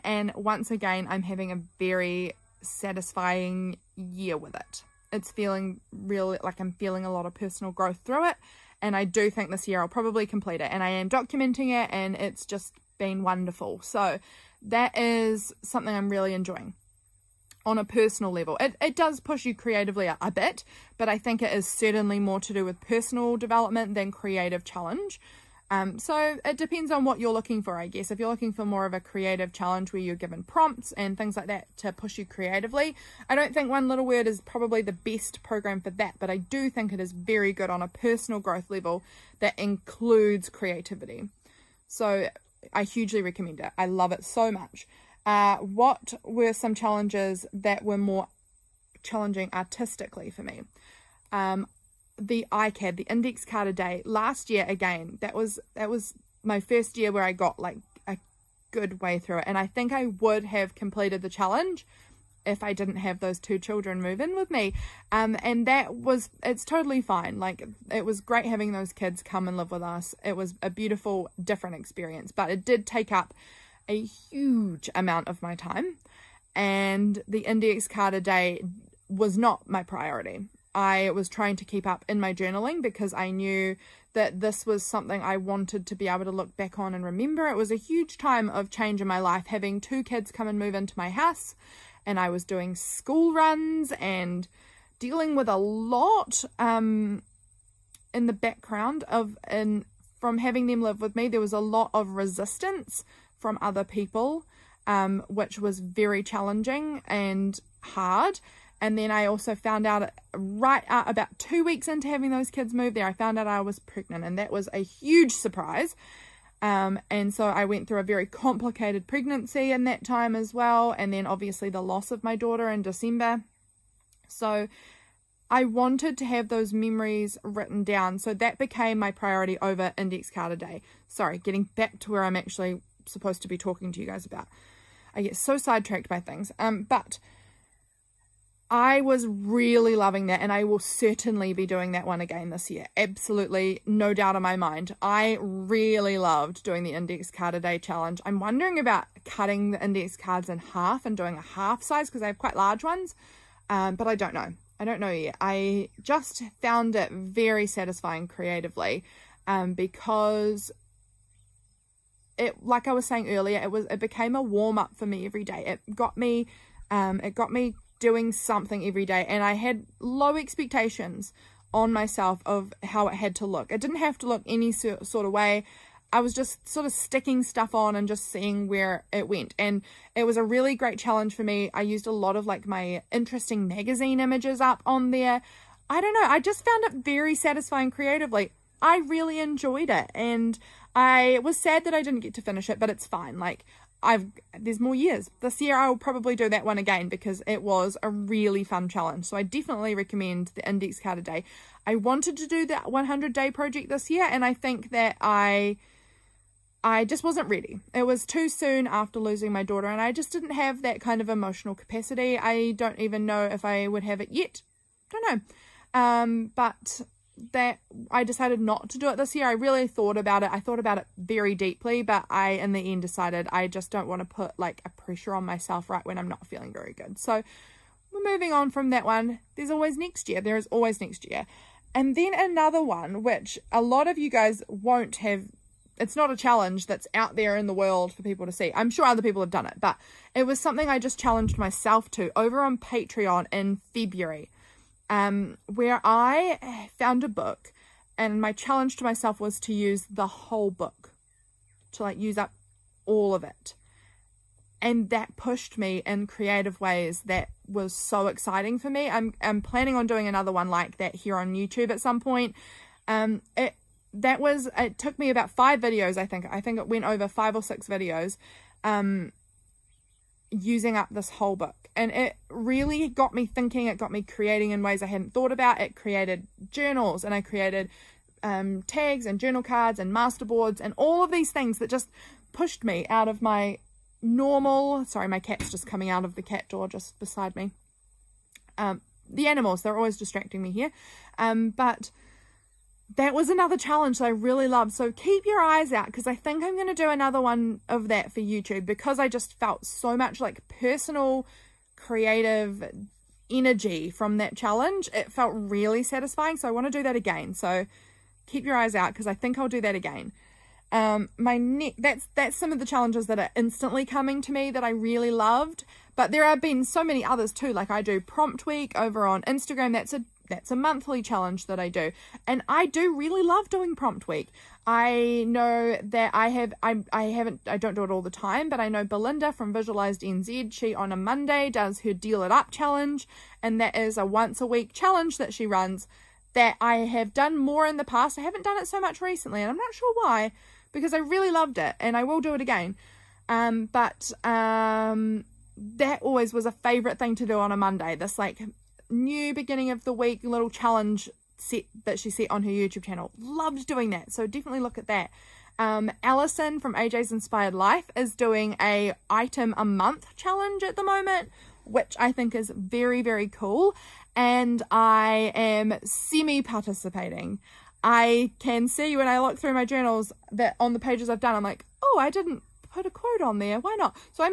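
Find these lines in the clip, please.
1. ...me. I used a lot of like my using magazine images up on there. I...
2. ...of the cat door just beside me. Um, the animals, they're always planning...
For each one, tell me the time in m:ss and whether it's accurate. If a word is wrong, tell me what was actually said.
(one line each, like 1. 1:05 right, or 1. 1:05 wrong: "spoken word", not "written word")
1. 3:01 wrong: "interesting", not "using"
2. 4:46 wrong: "distracting", not "planning".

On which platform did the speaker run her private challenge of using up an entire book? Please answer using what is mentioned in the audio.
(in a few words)
Patreon.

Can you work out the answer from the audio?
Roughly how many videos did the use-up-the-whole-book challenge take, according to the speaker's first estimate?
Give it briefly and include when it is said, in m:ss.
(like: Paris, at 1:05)
5, at 4:25.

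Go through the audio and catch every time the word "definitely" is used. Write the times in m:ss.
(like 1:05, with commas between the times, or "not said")
3:19, 5:54.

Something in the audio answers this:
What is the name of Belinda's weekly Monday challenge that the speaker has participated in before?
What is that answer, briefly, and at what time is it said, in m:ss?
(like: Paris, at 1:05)
Deal It Up, at 5:32.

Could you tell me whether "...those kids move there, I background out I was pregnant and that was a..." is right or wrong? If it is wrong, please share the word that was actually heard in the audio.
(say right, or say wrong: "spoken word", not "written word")
wrong: "found", not "background".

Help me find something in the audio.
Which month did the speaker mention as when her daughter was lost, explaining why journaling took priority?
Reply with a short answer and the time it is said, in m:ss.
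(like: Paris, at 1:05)
December, at 2:02.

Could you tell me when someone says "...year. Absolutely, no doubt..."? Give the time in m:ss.
2:22.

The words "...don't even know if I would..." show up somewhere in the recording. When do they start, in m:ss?
3:32.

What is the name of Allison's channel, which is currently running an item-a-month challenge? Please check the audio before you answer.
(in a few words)
AJ's Inspired Life.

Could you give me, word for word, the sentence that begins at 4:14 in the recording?
And that pushed me in creative ways that was so exciting for me.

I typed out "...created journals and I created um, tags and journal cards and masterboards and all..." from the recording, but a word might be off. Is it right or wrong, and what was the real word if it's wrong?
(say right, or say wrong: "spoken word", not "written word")
right.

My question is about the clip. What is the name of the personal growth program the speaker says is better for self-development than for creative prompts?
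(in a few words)
One Little Word.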